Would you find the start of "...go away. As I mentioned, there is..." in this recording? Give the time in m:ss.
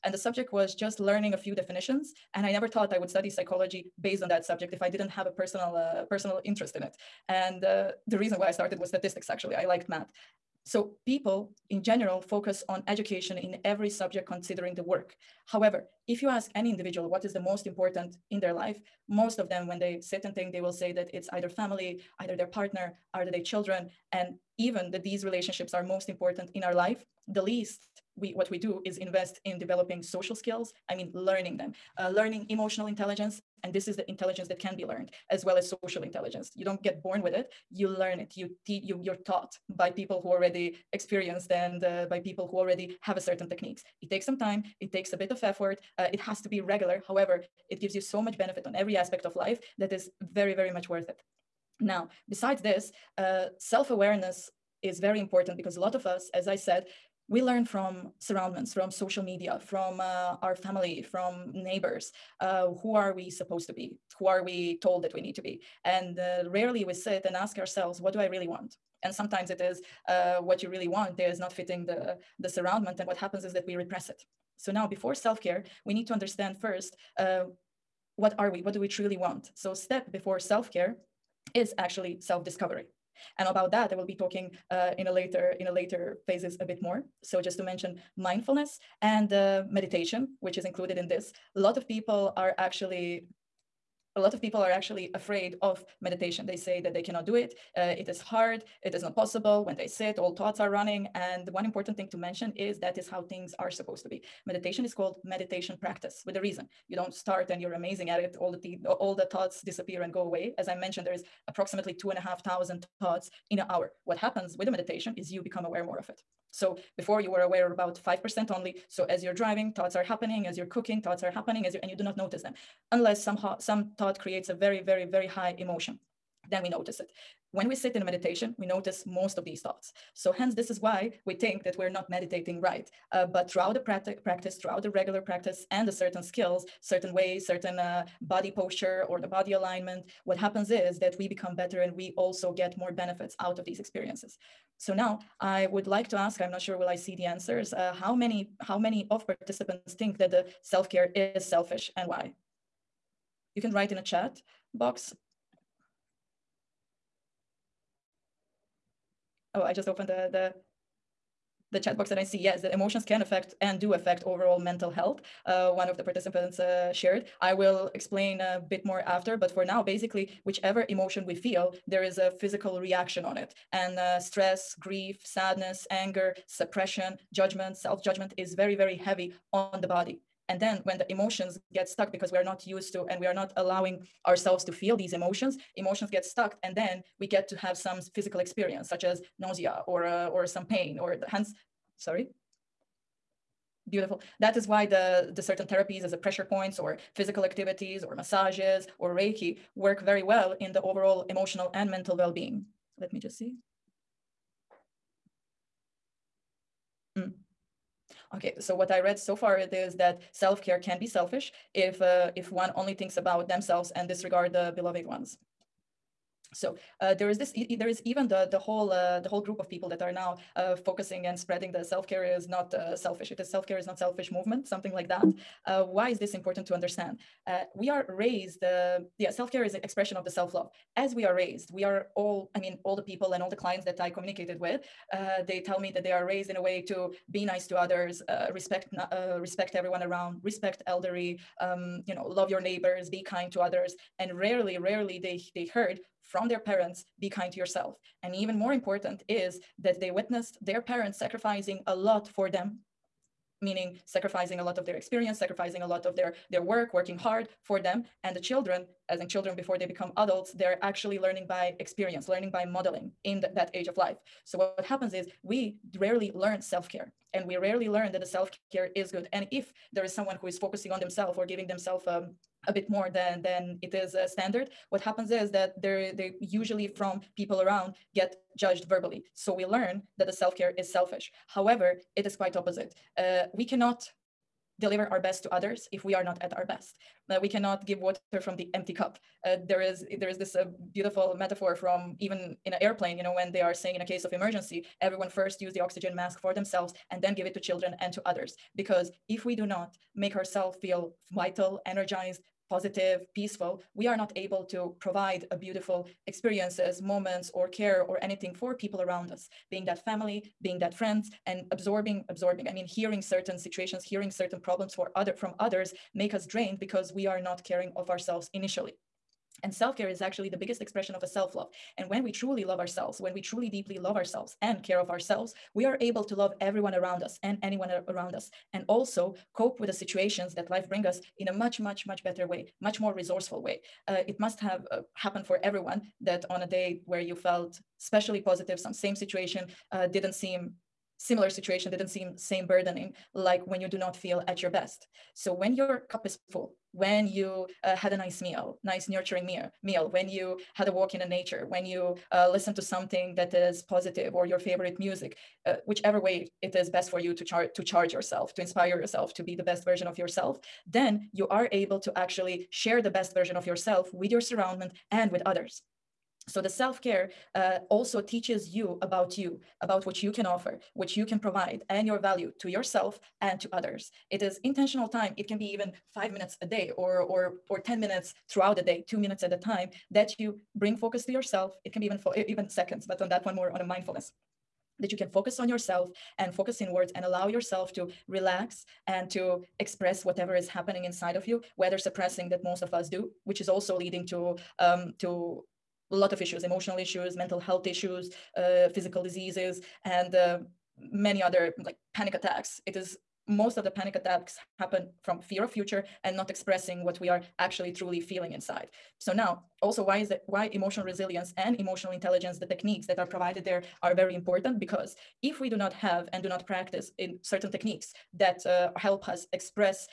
1:50.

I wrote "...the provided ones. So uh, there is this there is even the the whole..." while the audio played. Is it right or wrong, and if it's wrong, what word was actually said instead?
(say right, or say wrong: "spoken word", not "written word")
wrong: "beloved", not "provided".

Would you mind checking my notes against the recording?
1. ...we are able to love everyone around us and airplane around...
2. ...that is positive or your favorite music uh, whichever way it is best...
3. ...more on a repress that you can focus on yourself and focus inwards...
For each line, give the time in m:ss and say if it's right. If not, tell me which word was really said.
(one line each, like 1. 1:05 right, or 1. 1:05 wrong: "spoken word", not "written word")
1. 5:25 wrong: "anyone", not "airplane"
2. 5:53 right
3. 6:23 wrong: "mindfulness", not "repress".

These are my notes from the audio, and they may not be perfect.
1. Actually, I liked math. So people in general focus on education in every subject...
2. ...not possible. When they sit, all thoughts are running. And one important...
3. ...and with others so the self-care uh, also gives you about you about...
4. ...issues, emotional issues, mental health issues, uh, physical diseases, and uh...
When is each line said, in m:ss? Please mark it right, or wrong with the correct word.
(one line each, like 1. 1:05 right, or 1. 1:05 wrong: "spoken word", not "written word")
1. 0:09 right
2. 1:39 right
3. 6:05 wrong: "teaches", not "gives"
4. 6:36 right.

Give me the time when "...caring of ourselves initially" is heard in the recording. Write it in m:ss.
5:17.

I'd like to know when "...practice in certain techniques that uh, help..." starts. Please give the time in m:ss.
6:56.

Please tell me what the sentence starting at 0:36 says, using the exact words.
You don't get born with it, you learn it.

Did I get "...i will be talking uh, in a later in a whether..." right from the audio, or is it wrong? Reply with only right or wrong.
wrong.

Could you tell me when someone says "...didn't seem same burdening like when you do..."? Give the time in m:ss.
5:41.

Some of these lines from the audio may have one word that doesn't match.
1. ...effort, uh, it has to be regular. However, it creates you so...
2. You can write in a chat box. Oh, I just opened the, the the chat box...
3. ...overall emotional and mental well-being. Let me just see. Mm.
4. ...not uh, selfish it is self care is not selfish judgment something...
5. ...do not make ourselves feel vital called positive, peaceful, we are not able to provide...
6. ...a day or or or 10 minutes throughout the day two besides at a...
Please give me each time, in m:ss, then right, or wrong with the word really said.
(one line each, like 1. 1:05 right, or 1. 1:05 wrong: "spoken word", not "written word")
1. 0:45 wrong: "gives", not "creates"
2. 2:33 right
3. 3:20 right
4. 3:42 wrong: "movement", not "judgment"
5. 4:59 wrong: "energized", not "called"
6. 6:16 wrong: "minutes", not "besides".